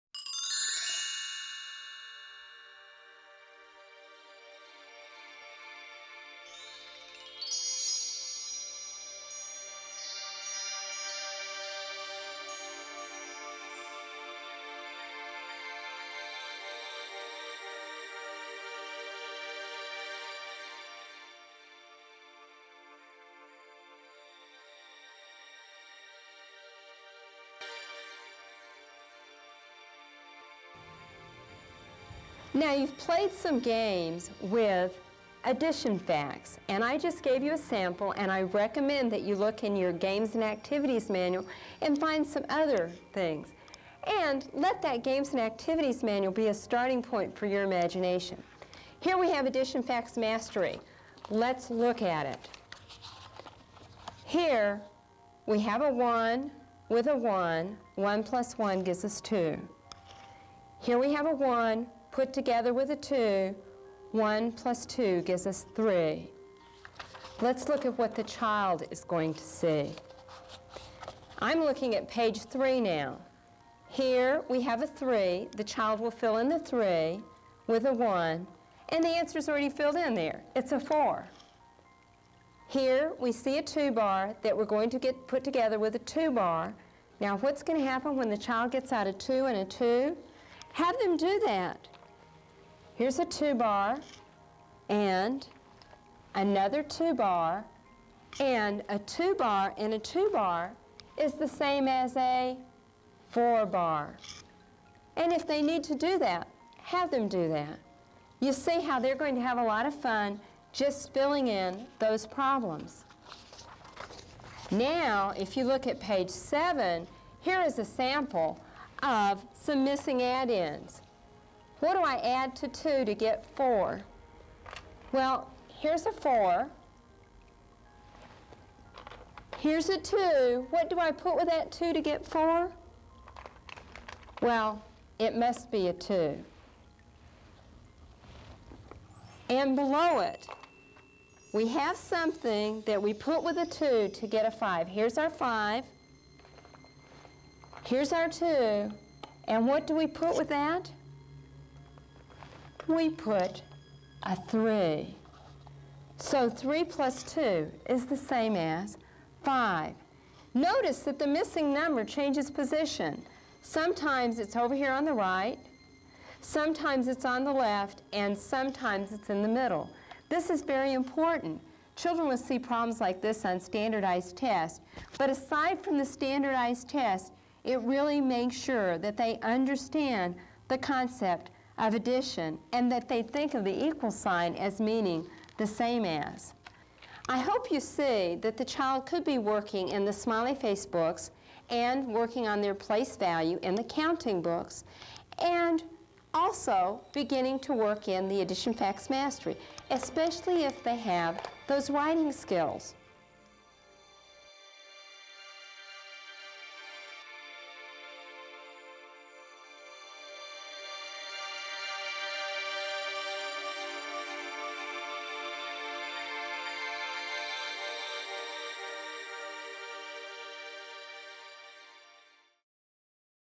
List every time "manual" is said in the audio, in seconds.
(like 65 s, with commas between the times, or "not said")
41 s, 46 s.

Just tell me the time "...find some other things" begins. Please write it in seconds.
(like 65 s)
41 s.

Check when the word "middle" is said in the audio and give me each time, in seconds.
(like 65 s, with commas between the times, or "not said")
169 s.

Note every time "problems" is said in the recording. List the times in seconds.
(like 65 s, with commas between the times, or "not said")
112 s, 172 s.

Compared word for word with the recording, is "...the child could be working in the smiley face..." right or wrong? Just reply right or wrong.
right.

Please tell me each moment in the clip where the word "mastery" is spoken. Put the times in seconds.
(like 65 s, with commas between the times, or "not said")
50 s, 199 s.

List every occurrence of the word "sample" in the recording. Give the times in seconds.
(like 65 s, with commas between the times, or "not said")
37 s, 117 s.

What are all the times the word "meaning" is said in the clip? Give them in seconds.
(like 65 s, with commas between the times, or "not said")
184 s.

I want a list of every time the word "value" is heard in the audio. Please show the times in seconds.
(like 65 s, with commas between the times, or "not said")
193 s.